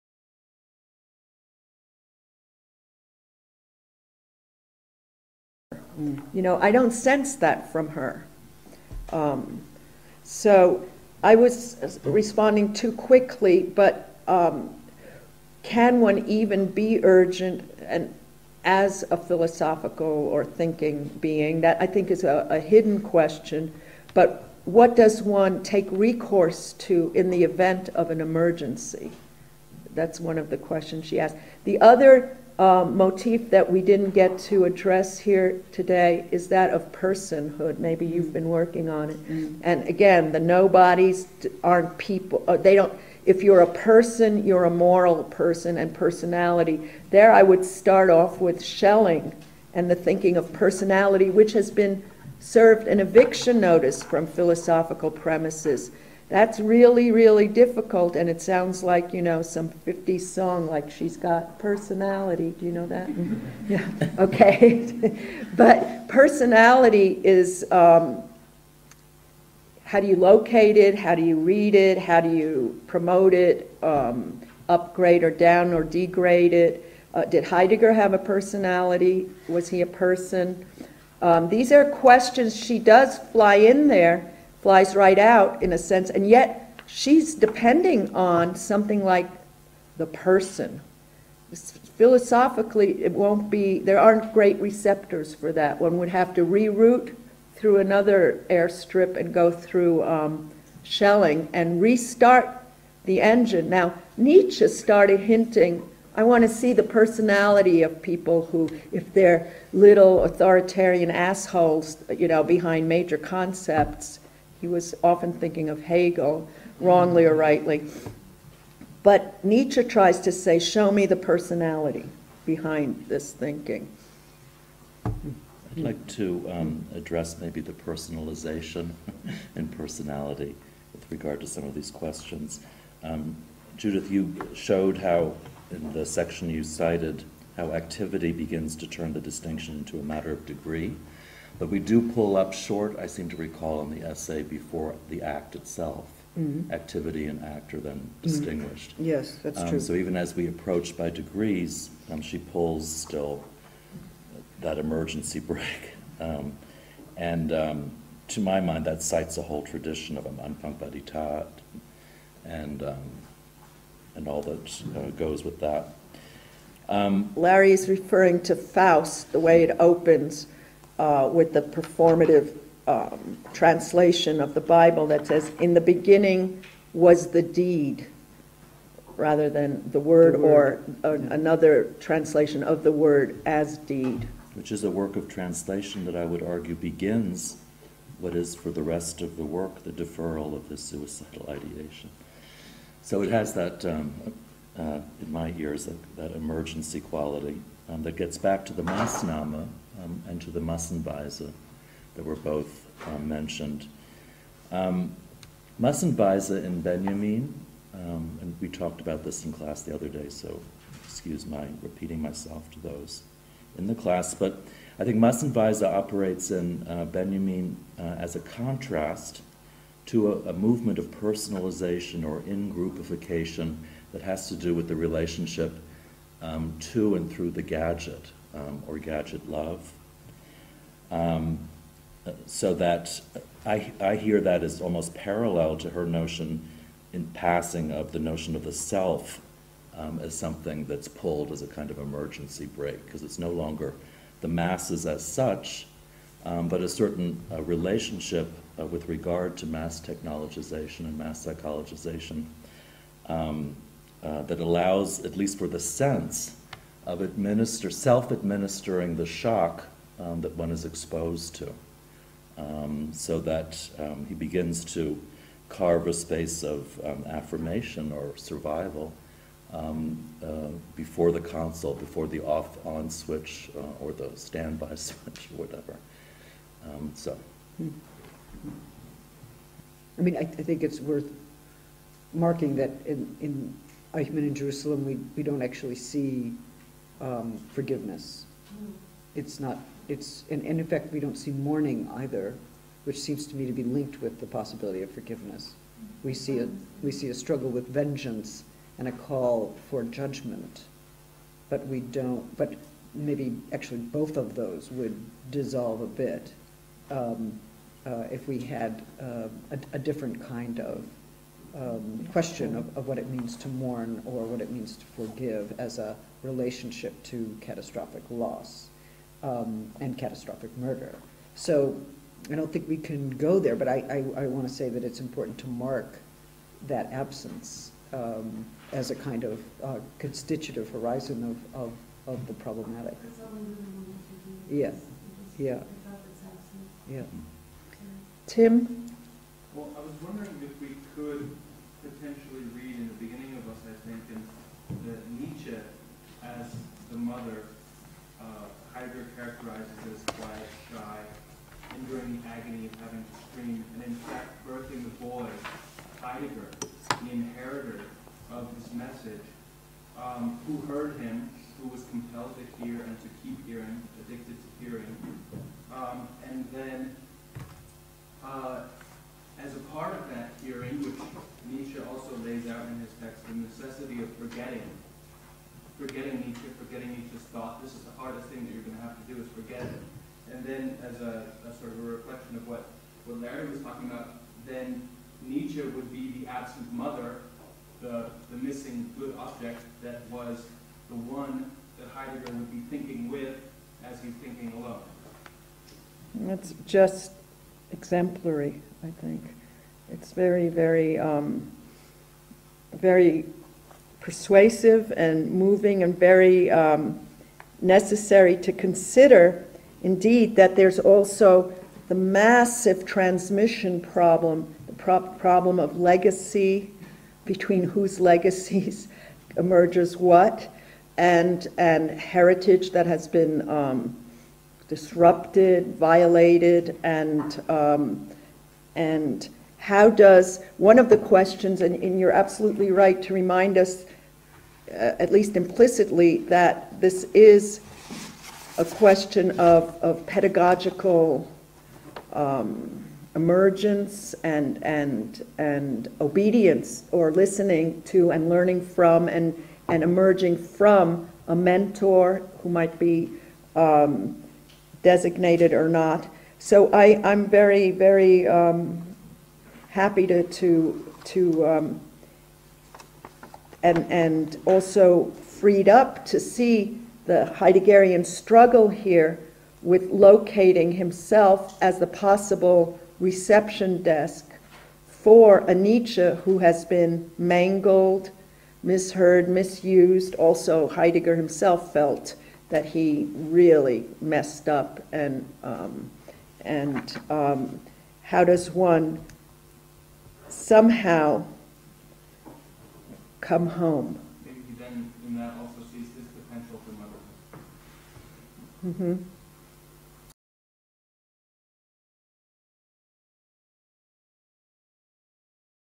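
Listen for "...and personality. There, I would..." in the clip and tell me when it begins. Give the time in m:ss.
0:45.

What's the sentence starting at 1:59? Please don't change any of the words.
But Nietzsche tries to say, show me the personality behind this thinking.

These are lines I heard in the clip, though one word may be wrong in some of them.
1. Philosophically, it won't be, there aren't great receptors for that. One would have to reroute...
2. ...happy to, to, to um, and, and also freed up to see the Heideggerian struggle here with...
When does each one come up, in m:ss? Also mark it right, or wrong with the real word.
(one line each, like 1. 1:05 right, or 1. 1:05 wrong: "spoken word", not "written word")
1. 1:31 right
2. 7:39 right.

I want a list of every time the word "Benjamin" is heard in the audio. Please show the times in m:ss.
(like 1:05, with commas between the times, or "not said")
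3:26, 3:37.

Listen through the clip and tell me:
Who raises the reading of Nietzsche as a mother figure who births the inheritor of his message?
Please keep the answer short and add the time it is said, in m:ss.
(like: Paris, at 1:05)
Tim, at 5:38.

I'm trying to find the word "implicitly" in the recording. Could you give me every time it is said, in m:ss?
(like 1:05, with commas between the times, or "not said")
7:15.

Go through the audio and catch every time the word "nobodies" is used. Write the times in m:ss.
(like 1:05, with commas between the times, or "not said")
0:40.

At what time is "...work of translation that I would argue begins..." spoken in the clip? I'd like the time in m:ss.
3:04.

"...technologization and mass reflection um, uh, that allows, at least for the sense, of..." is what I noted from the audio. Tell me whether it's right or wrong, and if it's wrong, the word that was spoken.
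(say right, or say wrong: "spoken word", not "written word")
wrong: "psychologization", not "reflection".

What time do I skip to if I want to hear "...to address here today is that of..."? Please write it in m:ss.
0:34.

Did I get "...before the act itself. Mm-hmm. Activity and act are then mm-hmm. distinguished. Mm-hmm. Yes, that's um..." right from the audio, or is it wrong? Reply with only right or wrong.
right.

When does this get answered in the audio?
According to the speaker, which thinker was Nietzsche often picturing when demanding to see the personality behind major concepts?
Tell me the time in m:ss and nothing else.
1:55.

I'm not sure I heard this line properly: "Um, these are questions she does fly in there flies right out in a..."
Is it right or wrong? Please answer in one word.
right.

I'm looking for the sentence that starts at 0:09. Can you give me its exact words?
Um, so I was responding too quickly, but um, can one even be urgent and as a philosophical or thinking being?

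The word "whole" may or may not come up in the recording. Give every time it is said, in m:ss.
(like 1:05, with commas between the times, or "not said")
2:39.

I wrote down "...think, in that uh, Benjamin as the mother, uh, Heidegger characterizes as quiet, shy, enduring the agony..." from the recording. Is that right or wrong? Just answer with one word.
wrong.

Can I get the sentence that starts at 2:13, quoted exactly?
Um, Judith, you showed how, in the section you cited, how activity begins to turn the distinction into a matter of degree.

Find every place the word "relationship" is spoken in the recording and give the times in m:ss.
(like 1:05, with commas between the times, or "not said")
3:44, 4:07, 5:16.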